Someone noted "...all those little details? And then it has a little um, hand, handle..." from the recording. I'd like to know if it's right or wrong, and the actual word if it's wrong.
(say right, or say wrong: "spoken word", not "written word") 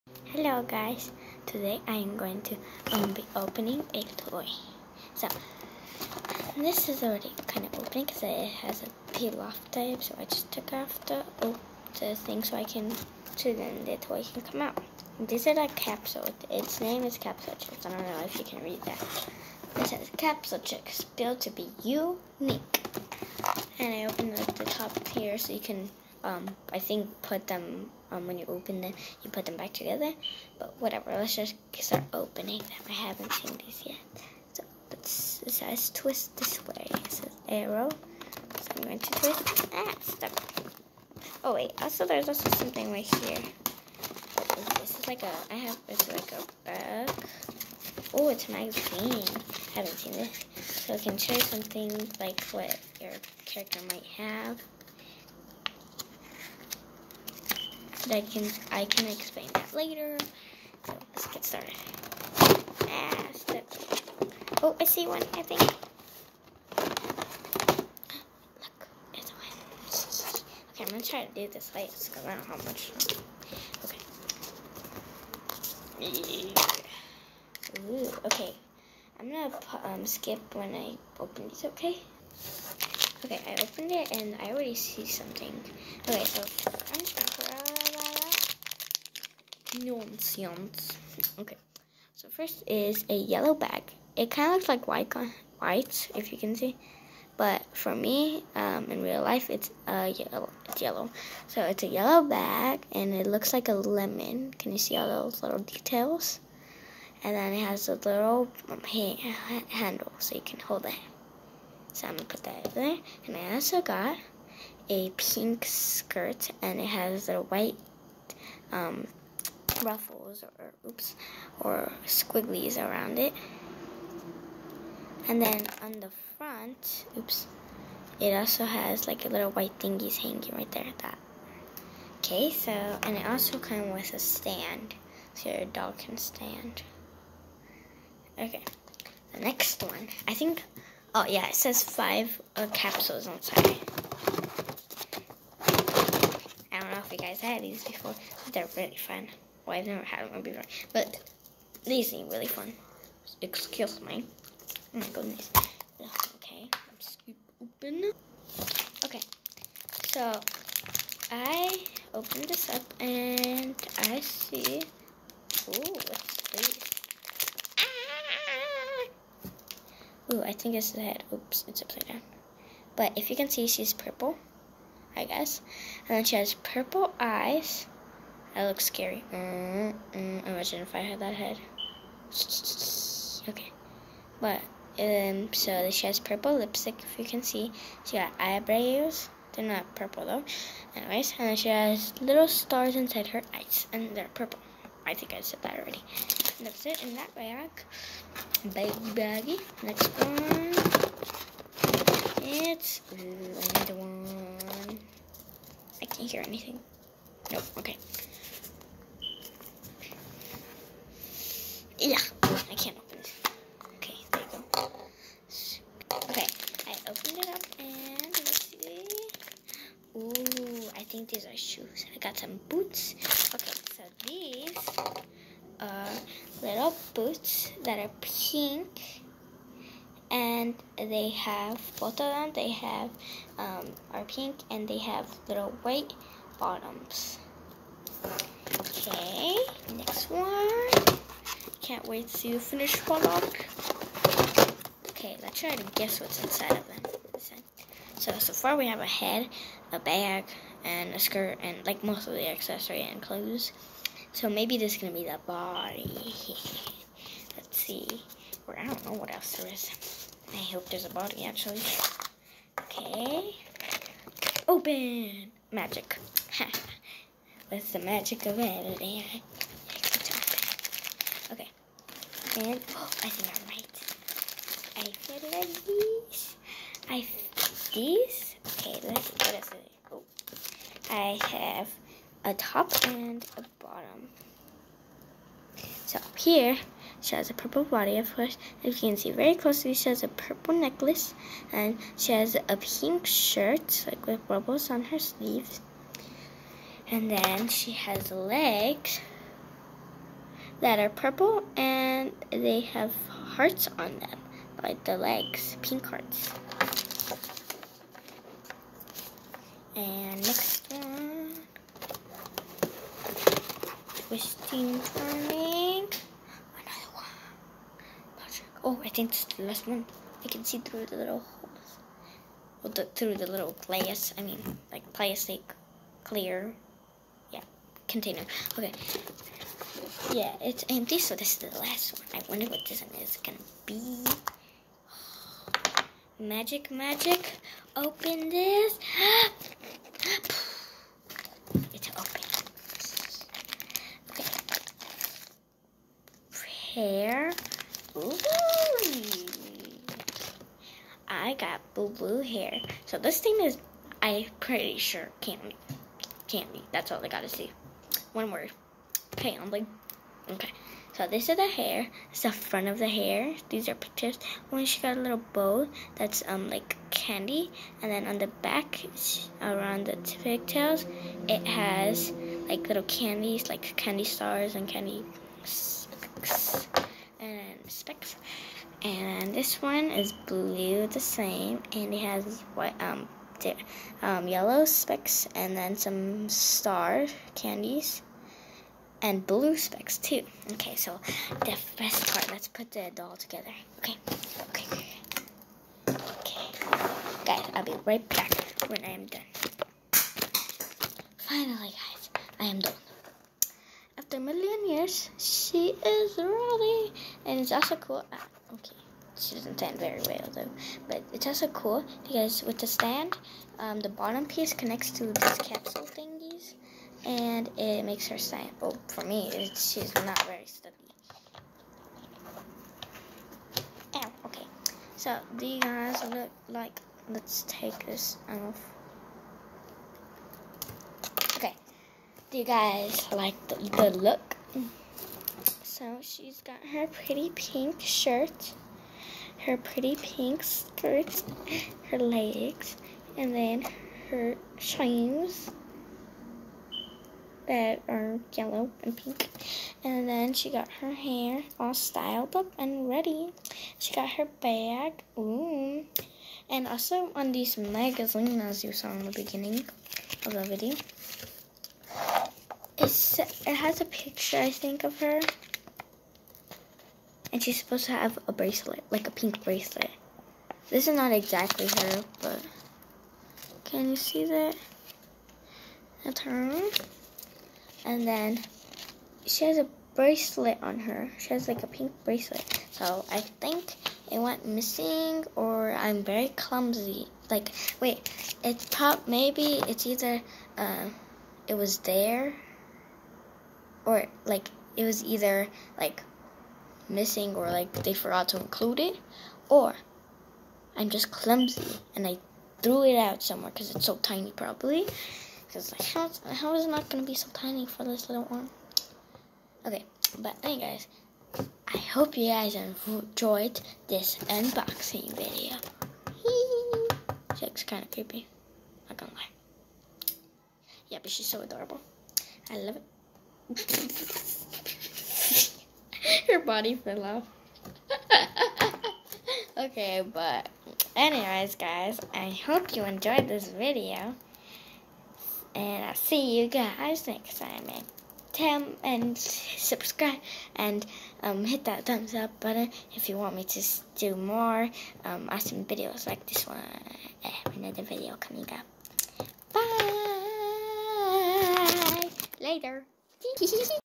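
right.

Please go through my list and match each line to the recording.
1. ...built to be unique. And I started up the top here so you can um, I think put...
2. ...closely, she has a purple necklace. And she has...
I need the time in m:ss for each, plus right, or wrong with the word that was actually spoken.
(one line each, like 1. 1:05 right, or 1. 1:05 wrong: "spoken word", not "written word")
1. 0:21 wrong: "opened", not "started"
2. 4:49 right.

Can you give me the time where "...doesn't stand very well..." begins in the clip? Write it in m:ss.
6:49.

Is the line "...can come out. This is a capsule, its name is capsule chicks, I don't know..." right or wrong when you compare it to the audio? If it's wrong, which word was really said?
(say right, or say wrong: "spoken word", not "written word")
right.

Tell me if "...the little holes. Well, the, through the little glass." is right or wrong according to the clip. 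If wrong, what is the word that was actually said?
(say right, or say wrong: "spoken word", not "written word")
right.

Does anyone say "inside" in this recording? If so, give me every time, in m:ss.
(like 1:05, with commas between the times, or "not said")
2:23, 3:12, 4:06.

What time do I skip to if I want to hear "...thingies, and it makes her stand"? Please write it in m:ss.
6:56.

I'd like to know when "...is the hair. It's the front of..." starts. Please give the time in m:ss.
6:01.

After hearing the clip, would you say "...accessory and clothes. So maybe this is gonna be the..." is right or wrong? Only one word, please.
right.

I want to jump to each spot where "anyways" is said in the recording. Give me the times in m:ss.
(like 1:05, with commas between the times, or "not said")
3:10, 8:30, 8:51.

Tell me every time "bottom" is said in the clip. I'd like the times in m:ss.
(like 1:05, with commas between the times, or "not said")
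3:56, 4:43, 6:54.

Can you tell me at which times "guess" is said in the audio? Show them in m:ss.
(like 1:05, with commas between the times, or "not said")
2:55, 4:05.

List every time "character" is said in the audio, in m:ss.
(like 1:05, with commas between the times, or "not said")
0:53.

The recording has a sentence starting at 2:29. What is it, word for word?
Well, I've never had one before, but these seem really fun.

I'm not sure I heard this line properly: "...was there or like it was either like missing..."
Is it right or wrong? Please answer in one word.
right.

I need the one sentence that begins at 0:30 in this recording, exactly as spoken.
But whatever, let's just start opening them.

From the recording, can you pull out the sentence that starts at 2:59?
Mm Imagine if I had that head.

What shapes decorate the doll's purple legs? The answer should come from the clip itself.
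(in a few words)
Pink hearts.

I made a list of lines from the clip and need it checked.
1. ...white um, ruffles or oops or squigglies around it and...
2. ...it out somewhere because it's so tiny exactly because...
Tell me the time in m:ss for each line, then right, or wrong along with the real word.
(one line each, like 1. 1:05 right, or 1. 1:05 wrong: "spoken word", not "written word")
1. 1:57 right
2. 8:23 wrong: "probably", not "exactly".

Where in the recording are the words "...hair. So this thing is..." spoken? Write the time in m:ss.
5:52.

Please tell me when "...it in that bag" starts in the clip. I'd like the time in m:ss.
3:16.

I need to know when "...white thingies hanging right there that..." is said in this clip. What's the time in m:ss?
2:09.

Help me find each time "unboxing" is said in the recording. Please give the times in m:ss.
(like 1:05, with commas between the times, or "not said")
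8:34.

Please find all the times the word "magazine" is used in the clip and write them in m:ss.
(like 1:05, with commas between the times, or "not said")
0:48, 7:37.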